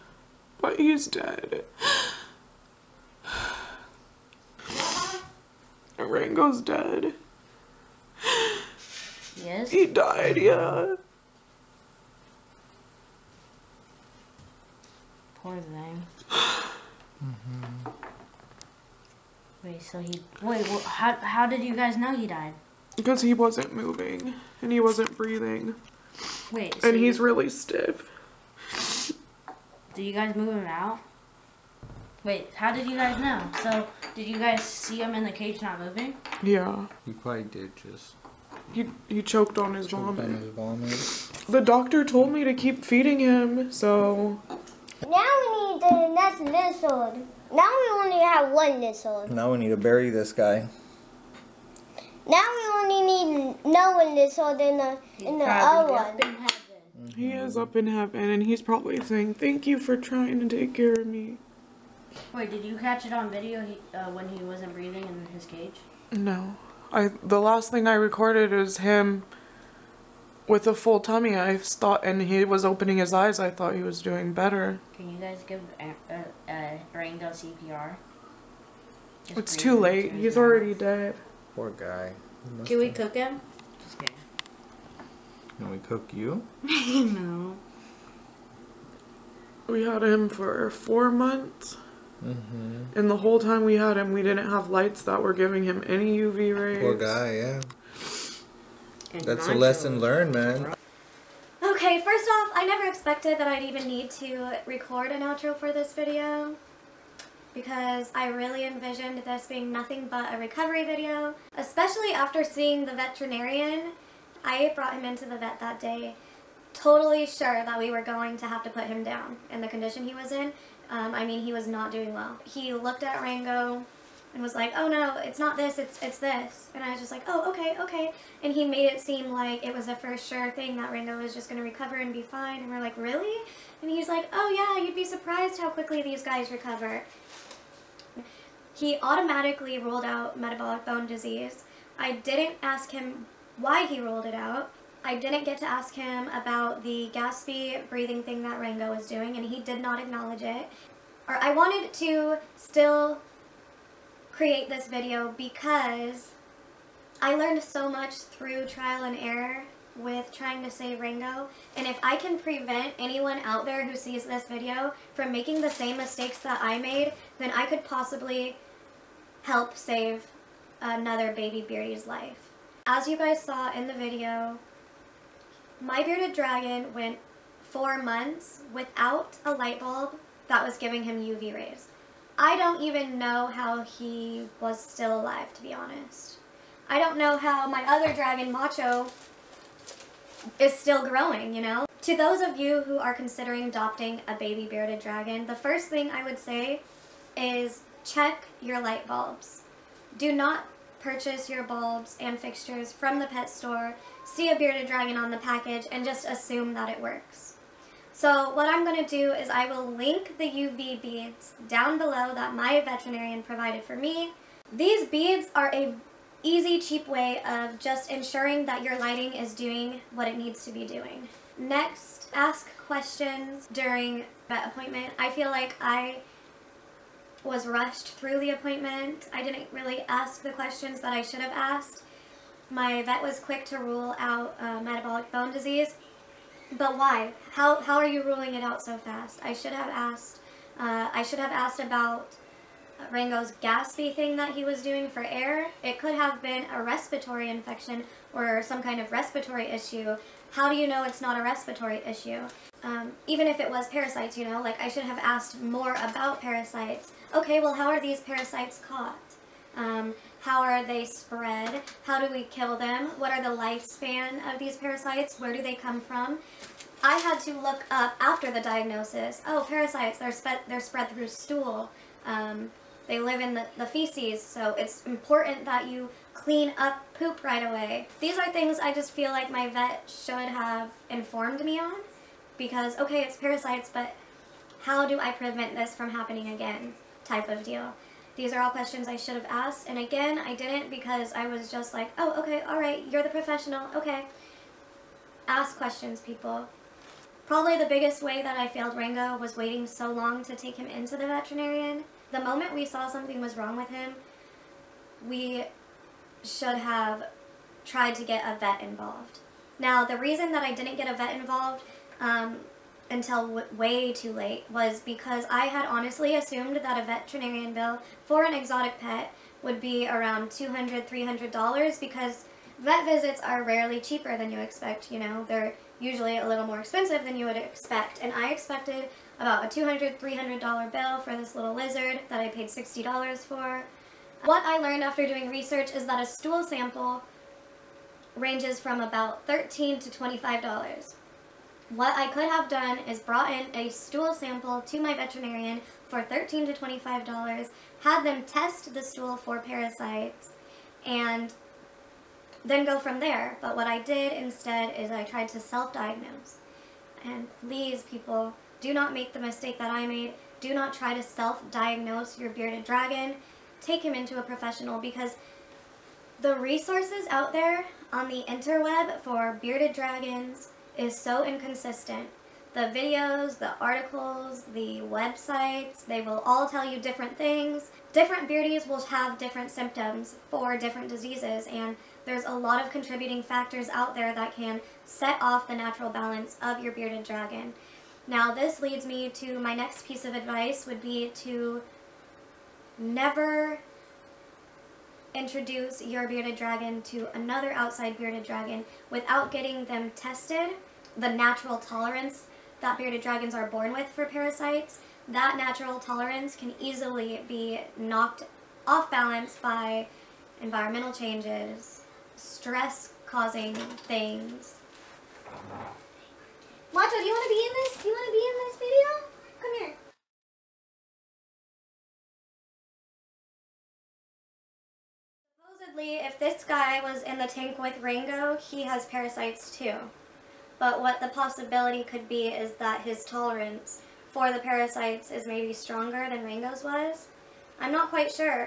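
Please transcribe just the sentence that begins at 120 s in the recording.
Um, I mean, he was not doing well.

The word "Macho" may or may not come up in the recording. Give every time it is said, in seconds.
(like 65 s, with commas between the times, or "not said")
188 s, 416 s.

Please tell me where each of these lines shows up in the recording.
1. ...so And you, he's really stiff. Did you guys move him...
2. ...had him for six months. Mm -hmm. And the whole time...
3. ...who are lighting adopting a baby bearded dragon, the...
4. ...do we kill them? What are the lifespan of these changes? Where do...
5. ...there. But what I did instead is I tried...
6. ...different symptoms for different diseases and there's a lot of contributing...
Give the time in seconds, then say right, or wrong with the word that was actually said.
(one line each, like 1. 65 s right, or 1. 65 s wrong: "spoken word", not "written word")
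1. 26 s right
2. 89 s wrong: "four", not "six"
3. 192 s wrong: "considering", not "lighting"
4. 262 s wrong: "parasites", not "changes"
5. 353 s right
6. 379 s right.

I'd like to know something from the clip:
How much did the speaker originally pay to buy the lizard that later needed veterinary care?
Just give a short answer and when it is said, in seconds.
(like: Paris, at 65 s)
$60, at 332 s.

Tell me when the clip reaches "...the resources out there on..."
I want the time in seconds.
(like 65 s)
366 s.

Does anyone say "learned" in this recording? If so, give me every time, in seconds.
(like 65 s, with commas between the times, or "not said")
100 s, 157 s, 334 s.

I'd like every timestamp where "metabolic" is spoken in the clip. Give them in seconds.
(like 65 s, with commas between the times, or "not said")
140 s, 234 s.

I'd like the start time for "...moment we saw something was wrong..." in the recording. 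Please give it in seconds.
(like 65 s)
302 s.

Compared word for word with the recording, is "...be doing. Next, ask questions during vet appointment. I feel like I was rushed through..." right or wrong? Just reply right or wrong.
right.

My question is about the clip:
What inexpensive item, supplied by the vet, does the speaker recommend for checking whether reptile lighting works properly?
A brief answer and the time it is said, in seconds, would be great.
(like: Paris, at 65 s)
UV beads, at 210 s.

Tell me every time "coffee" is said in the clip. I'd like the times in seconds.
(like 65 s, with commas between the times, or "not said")
not said.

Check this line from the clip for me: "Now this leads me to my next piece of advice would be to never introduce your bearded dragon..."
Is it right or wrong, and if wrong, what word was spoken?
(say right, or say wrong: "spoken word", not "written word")
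right.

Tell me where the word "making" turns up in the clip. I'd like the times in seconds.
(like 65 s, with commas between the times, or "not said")
165 s.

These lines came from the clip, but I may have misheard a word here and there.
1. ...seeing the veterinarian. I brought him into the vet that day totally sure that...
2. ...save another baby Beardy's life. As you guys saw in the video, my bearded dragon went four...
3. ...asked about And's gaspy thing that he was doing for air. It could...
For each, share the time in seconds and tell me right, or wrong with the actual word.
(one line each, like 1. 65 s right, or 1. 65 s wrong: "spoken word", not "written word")
1. 112 s right
2. 169 s right
3. 241 s wrong: "Rango", not "And".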